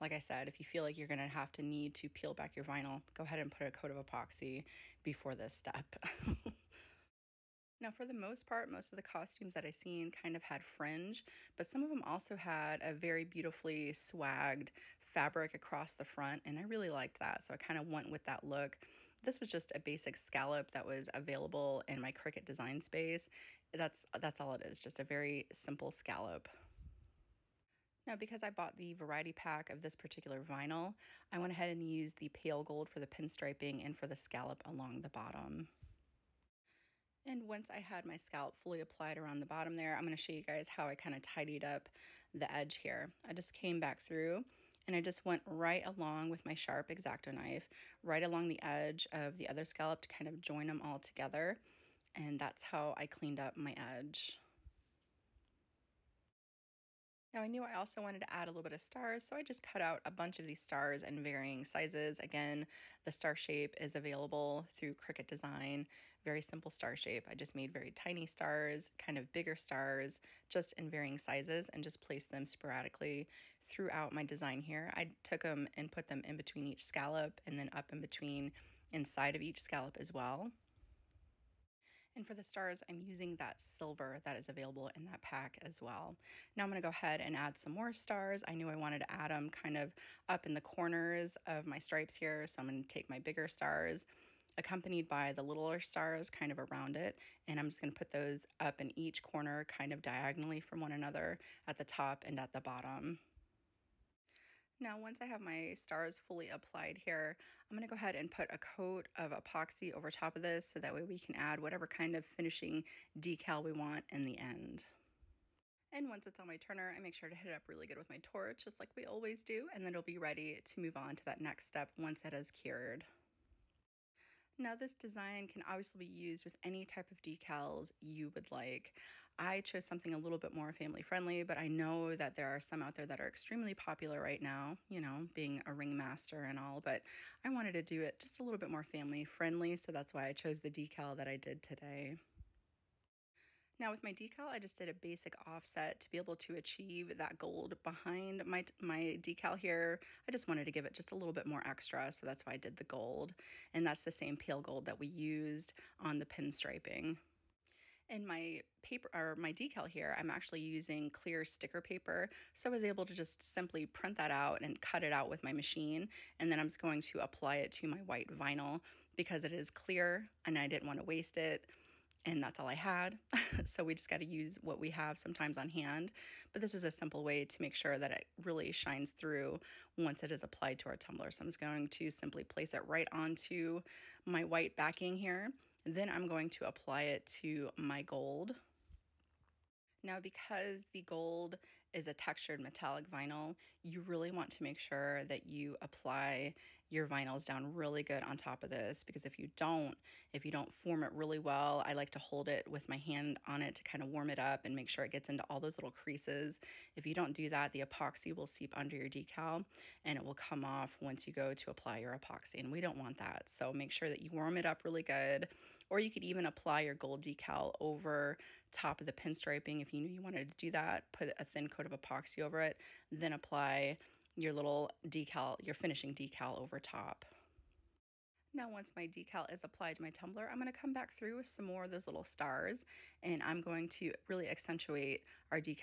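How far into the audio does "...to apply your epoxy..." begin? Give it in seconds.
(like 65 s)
211 s.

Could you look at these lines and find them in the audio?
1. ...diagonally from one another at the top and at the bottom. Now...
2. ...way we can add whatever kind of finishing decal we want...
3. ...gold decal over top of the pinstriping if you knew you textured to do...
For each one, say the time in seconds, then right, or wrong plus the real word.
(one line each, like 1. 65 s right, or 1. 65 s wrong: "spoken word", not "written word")
1. 100 s right
2. 110 s right
3. 216 s wrong: "wanted", not "textured".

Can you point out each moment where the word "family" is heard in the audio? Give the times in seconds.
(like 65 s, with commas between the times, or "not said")
130 s, 138 s.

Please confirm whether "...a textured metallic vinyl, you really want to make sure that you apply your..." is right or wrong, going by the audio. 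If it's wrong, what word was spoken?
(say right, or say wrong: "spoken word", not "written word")
right.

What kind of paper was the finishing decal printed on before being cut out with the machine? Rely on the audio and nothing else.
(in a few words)
clear sticker paper.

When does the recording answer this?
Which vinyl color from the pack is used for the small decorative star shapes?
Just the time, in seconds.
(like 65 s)
83 s.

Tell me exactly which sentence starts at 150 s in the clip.
I just wanted to give it just a little bit more extra, so that's why I did the gold.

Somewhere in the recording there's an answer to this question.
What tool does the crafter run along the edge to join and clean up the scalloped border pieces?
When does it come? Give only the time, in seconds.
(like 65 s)
46 s.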